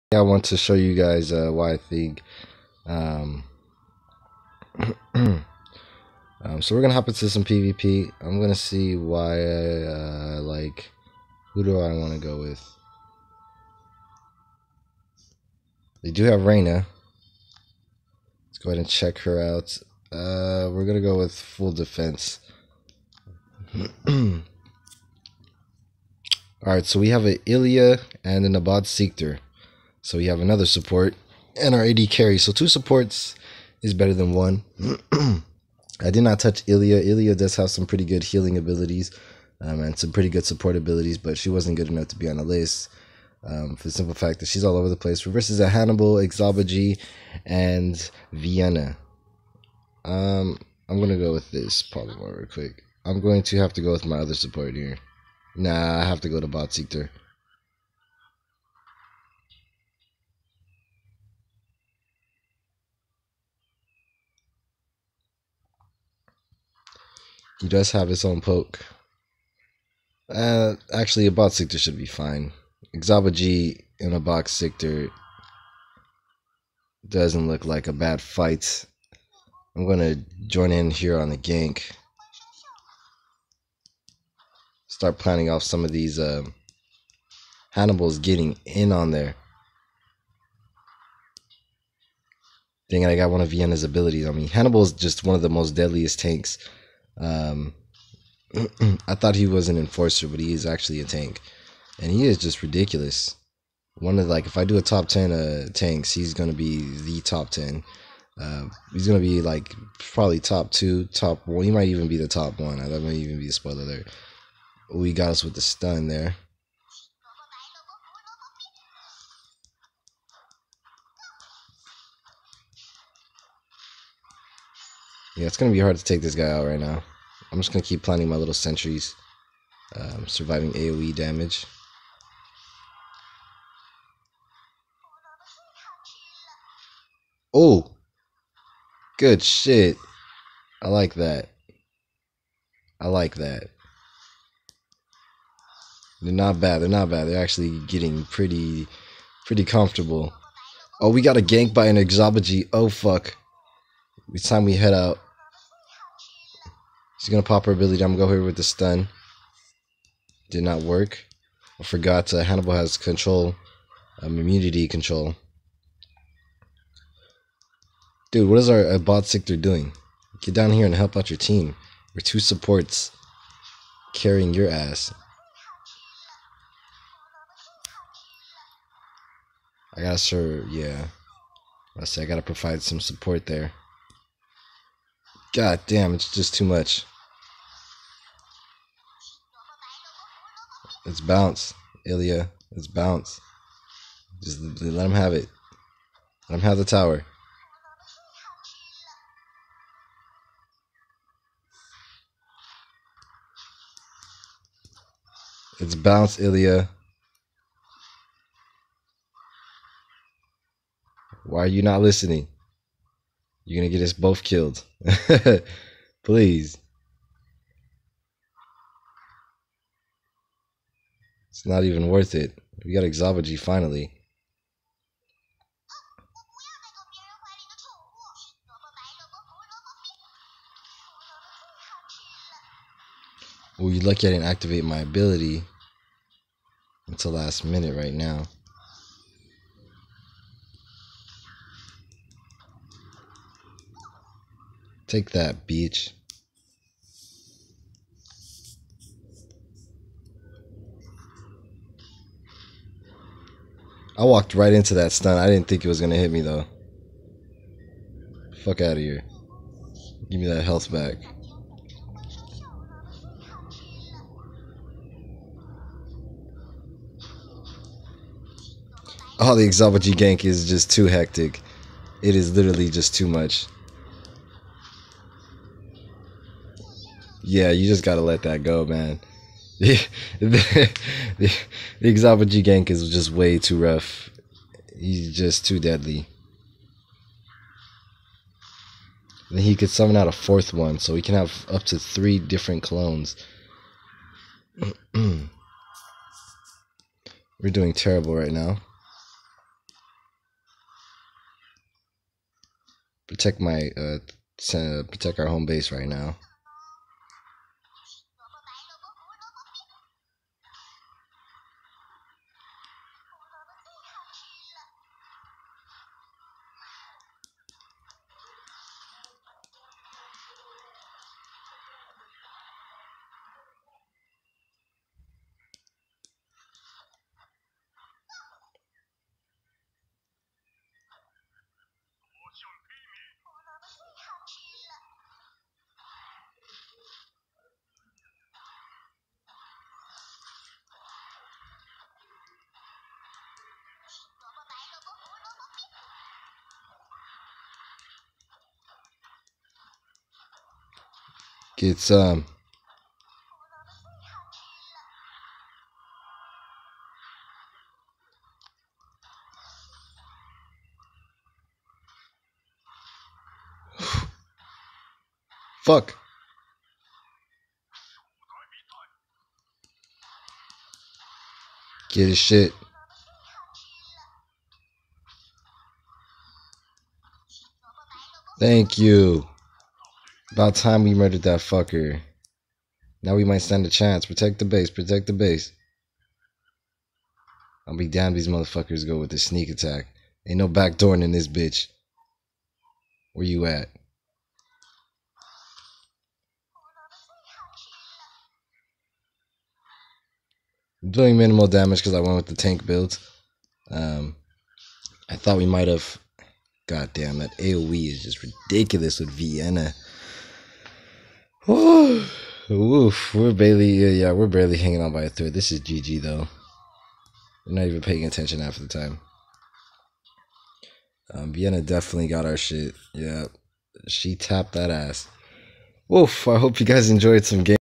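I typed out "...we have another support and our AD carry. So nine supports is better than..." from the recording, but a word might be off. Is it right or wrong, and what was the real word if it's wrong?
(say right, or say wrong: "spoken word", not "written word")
wrong: "two", not "nine".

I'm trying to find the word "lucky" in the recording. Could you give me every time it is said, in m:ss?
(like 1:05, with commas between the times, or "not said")
3:54.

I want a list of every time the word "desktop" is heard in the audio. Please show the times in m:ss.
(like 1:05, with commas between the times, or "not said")
not said.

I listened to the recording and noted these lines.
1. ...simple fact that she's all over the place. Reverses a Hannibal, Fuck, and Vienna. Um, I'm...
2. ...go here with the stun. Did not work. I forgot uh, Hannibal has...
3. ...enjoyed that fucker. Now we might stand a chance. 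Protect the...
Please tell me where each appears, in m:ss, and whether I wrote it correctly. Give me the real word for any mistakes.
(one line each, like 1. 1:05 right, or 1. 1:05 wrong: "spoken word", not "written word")
1. 0:43 wrong: "Exobogy", not "Fuck"
2. 2:38 right
3. 6:21 wrong: "murdered", not "enjoyed".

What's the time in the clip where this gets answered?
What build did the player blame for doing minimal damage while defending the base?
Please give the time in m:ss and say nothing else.
6:42.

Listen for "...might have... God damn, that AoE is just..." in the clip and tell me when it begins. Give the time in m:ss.
6:45.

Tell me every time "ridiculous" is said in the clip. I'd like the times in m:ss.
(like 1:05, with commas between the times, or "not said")
1:42, 6:48.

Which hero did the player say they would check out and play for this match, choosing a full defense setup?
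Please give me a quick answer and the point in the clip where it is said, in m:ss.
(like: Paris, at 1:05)
Reyna, at 0:16.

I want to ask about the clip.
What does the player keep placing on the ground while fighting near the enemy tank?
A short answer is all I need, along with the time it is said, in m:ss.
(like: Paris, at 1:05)
Sentries, at 2:08.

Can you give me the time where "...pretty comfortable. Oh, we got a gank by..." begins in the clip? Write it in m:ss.
2:29.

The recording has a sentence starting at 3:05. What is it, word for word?
God damn, it's just too much.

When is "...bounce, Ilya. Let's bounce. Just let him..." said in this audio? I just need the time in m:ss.
3:11.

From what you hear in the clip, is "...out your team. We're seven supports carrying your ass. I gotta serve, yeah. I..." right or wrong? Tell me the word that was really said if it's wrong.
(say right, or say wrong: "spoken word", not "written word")
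wrong: "two", not "seven".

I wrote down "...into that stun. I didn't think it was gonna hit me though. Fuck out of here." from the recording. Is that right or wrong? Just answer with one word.
right.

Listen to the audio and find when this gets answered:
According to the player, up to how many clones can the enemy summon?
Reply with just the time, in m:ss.
4:51.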